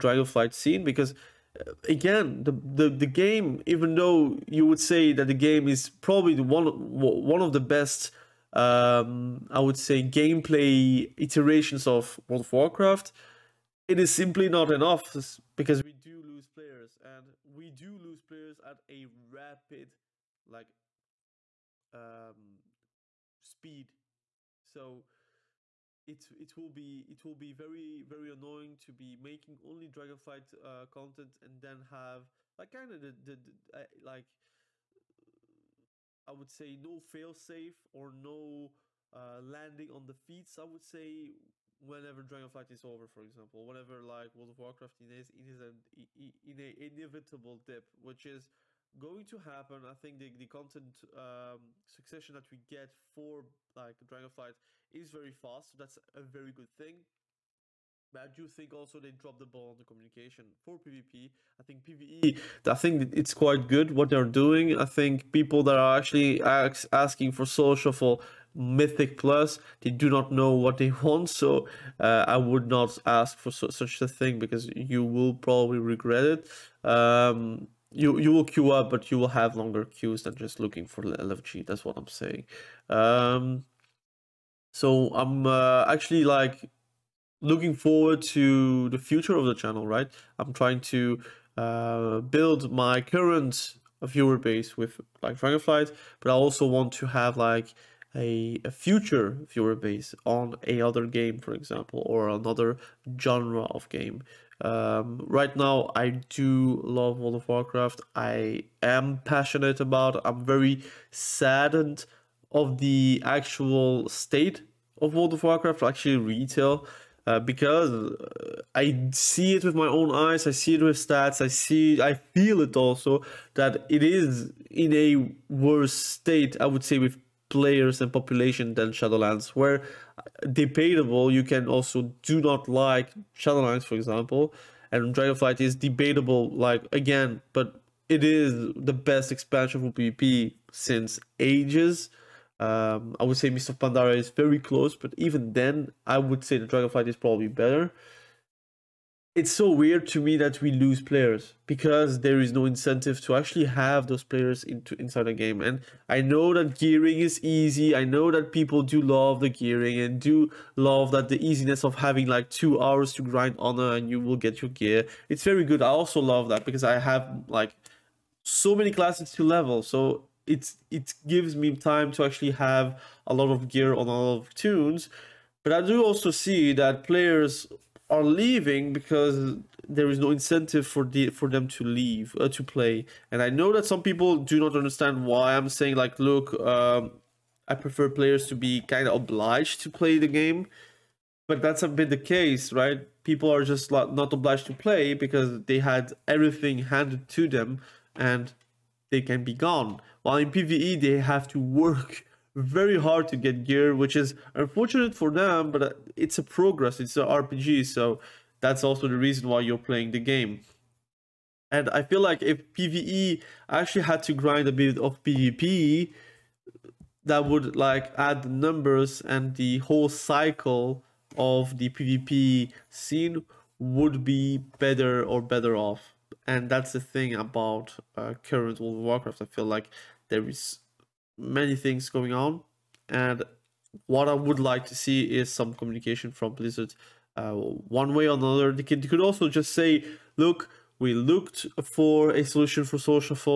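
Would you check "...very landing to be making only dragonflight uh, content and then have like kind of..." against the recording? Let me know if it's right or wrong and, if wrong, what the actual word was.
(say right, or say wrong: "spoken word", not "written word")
wrong: "annoying", not "landing".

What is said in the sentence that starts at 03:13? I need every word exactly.
People are just not obliged to play because they had everything handed to them and they can be gone.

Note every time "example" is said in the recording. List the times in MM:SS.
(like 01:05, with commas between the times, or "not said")
00:43, 01:41, 02:13.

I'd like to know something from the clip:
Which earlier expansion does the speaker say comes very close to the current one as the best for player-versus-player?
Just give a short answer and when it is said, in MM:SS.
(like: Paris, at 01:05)
Mists of Pandaria, at 02:23.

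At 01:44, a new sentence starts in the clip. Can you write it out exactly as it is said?
Um, right now, I do love World of Warcraft.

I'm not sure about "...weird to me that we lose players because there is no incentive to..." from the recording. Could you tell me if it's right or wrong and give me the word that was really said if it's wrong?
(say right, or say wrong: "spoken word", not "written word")
right.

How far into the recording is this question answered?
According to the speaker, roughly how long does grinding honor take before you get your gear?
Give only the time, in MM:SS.
02:42.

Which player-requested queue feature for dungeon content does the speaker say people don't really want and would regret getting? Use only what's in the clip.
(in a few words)
Solo shuffle Mythic Plus.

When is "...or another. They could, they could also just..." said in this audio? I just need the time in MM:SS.
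03:58.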